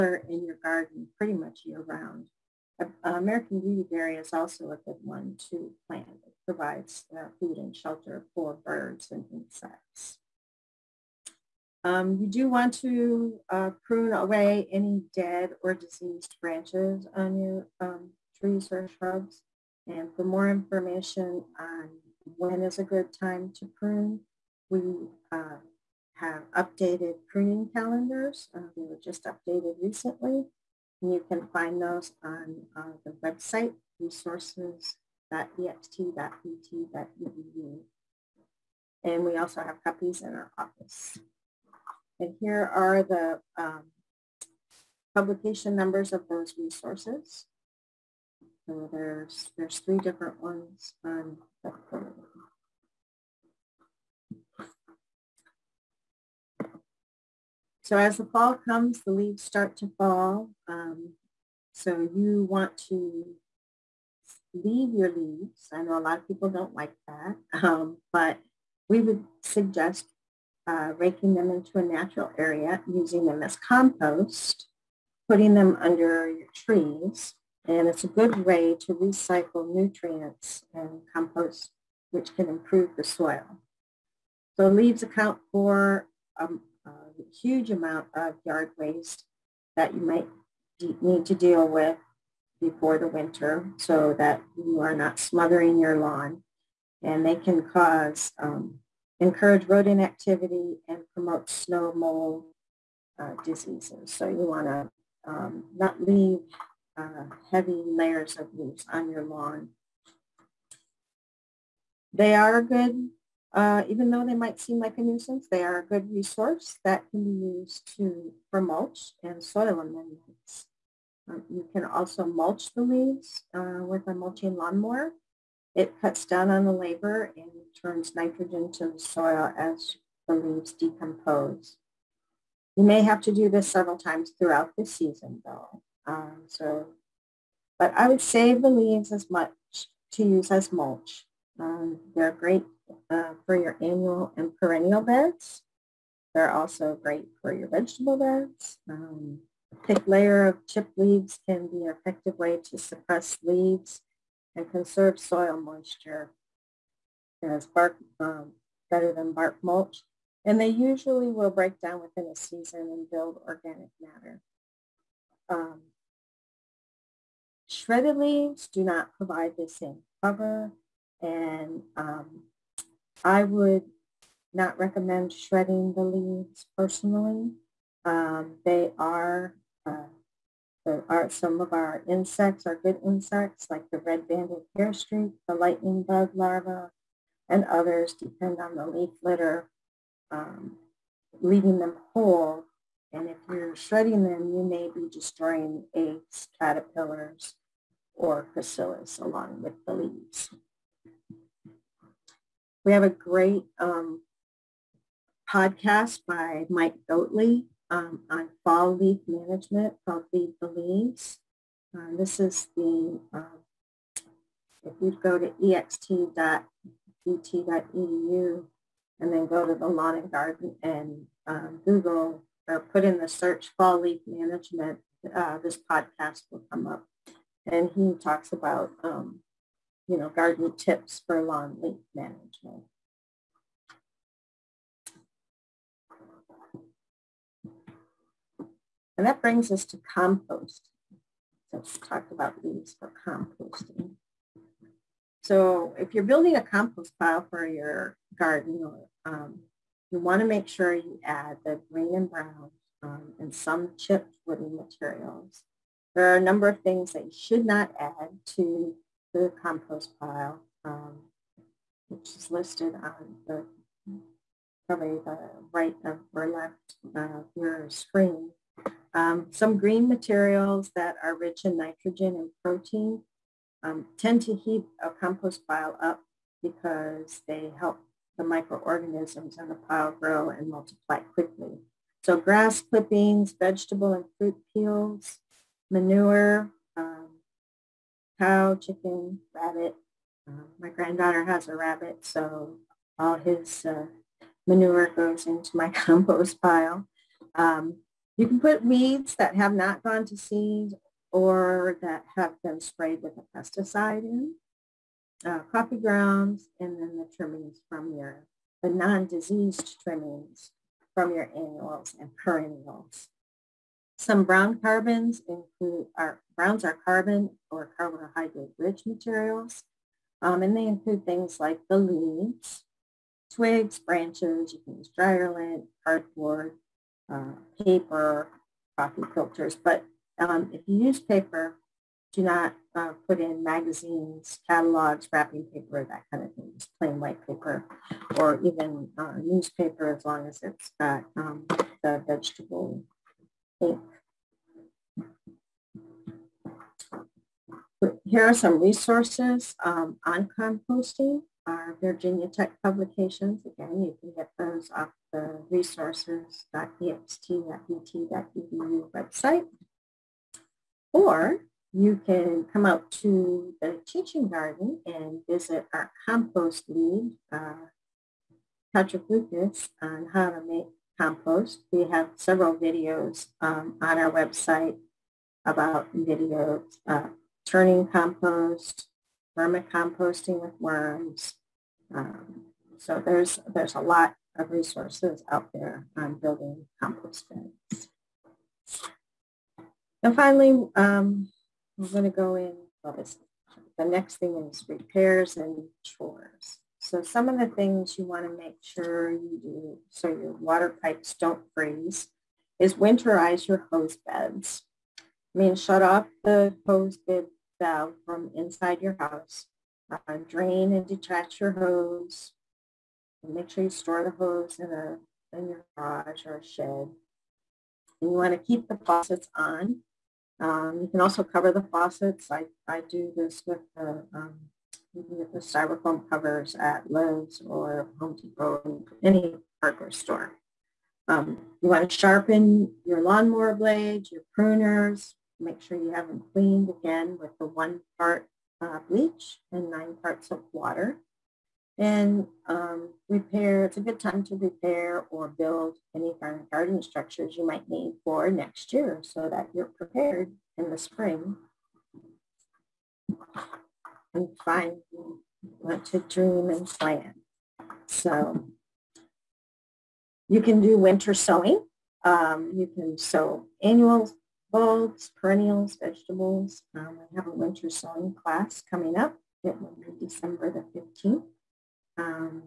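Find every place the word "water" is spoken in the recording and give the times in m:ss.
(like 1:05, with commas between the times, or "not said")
6:40, 7:20.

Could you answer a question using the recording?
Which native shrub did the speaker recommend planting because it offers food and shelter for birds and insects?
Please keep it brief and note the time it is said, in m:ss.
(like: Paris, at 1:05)
American beautyberry, at 0:03.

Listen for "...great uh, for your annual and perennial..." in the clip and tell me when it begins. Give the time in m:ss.
2:22.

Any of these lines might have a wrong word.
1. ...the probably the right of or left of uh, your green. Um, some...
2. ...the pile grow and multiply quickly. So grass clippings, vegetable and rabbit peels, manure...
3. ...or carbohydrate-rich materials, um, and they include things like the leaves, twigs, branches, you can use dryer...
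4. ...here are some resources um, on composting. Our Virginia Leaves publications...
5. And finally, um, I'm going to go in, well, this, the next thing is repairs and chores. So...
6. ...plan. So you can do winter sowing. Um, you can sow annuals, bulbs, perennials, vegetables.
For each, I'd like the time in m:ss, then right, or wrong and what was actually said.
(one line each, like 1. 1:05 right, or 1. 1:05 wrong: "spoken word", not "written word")
1. 4:23 wrong: "screen", not "green"
2. 4:39 wrong: "fruit", not "rabbit"
3. 5:17 right
4. 5:48 wrong: "Tech", not "Leaves"
5. 6:30 right
6. 7:36 right.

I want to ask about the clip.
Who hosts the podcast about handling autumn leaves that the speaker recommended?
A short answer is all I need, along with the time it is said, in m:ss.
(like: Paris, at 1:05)
Mike Goatley, at 3:26.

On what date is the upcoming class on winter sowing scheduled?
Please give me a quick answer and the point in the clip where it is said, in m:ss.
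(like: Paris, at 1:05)
December 15, at 7:50.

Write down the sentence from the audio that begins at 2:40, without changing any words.
And they usually will break down within a season and build organic matter.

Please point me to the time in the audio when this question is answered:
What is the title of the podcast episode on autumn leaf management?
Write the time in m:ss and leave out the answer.
3:30.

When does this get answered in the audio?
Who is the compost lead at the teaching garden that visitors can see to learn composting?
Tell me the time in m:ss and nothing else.
6:08.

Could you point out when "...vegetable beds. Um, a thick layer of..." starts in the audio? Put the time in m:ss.
2:27.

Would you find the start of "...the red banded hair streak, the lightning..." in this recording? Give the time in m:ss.
3:03.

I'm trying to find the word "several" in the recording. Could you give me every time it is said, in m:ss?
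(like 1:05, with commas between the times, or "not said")
2:13, 6:12.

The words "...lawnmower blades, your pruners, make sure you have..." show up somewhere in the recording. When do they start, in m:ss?
7:13.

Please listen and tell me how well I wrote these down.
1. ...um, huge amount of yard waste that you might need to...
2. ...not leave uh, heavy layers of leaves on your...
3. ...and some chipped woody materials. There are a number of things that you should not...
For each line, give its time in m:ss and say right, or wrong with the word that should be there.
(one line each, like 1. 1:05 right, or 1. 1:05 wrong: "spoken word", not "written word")
1. 1:26 right
2. 1:45 right
3. 4:13 right.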